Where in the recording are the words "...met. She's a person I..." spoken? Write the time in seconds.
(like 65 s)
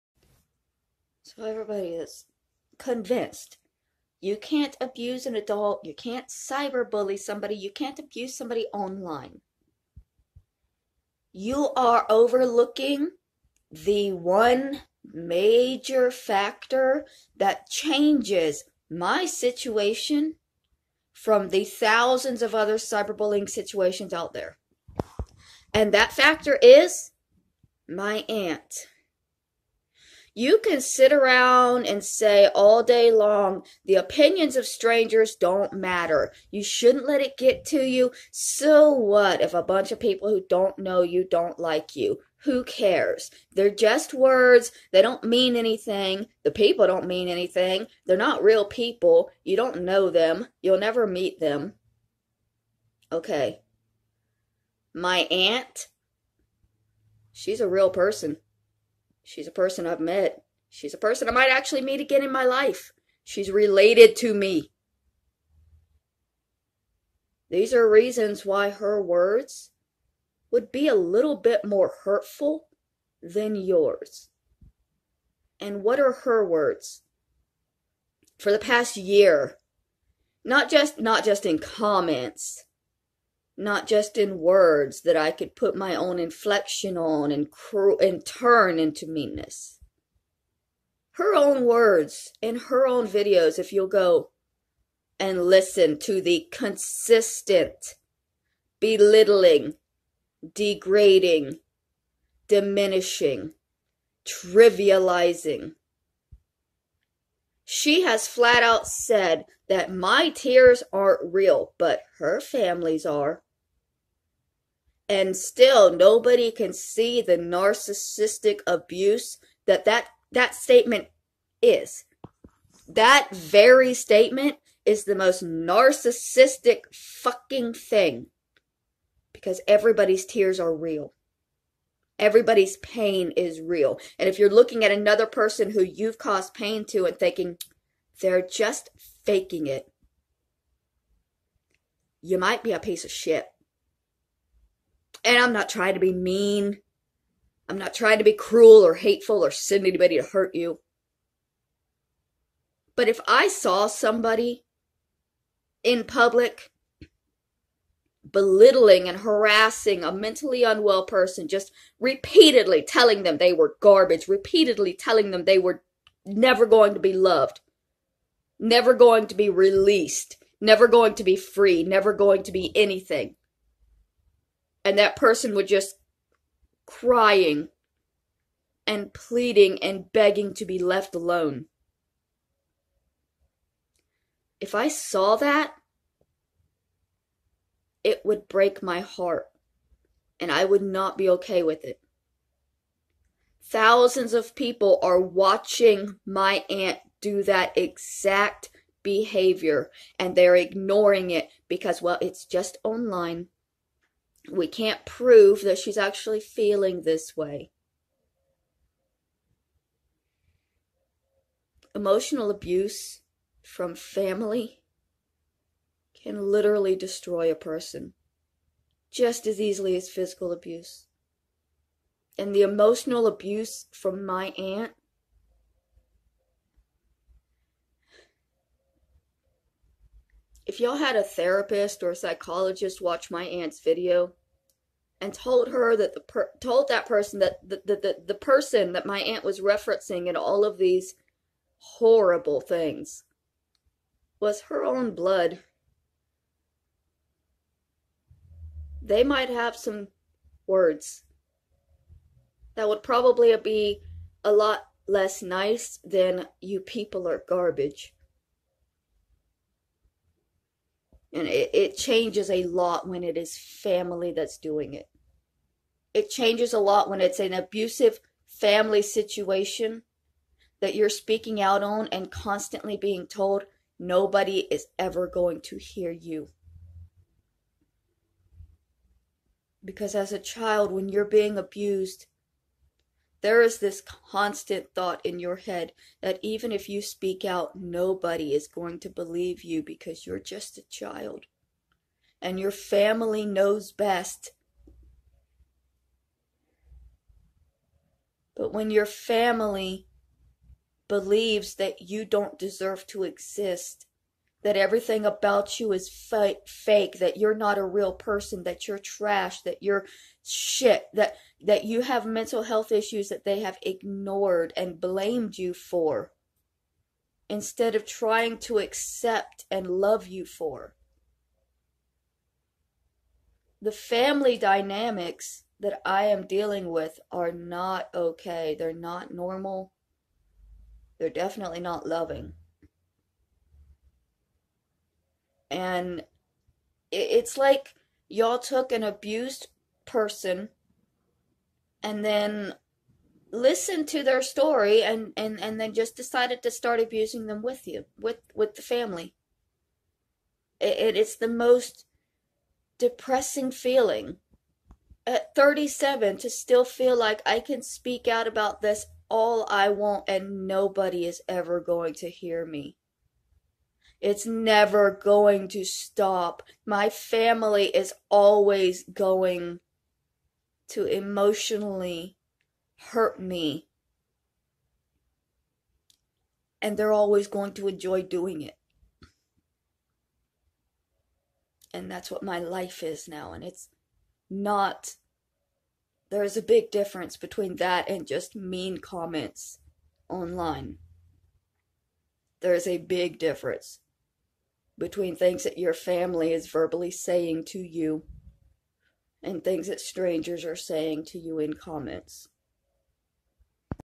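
59 s.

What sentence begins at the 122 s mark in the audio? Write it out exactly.
That very statement is the most narcissistic fucking thing because everybody's tears are real.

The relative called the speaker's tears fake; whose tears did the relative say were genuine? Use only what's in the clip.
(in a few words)
her family's.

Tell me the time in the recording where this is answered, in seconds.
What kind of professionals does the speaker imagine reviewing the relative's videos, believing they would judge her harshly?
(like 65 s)
231 s.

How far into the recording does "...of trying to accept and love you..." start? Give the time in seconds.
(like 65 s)
317 s.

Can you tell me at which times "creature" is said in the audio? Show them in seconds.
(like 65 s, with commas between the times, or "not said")
not said.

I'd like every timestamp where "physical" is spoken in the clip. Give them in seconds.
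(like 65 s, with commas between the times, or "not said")
220 s.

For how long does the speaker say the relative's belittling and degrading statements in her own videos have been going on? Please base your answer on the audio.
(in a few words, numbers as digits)
the past year.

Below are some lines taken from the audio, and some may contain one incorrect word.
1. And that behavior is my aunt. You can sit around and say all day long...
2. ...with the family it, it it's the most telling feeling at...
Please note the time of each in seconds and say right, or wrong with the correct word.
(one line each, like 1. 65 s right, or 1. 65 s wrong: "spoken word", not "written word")
1. 25 s wrong: "factor", not "behavior"
2. 348 s wrong: "depressing", not "telling".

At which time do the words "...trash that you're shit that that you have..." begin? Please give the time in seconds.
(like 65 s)
308 s.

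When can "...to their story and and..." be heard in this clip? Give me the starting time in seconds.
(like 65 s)
344 s.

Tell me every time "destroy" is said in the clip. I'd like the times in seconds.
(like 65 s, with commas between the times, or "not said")
216 s.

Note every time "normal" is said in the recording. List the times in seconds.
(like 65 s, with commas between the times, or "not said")
329 s.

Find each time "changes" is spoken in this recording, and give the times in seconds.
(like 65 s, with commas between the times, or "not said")
17 s, 261 s, 266 s.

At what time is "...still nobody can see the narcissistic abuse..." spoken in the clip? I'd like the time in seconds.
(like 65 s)
115 s.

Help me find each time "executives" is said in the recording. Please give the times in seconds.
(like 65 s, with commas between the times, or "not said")
not said.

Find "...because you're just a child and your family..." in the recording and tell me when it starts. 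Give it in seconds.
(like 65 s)
289 s.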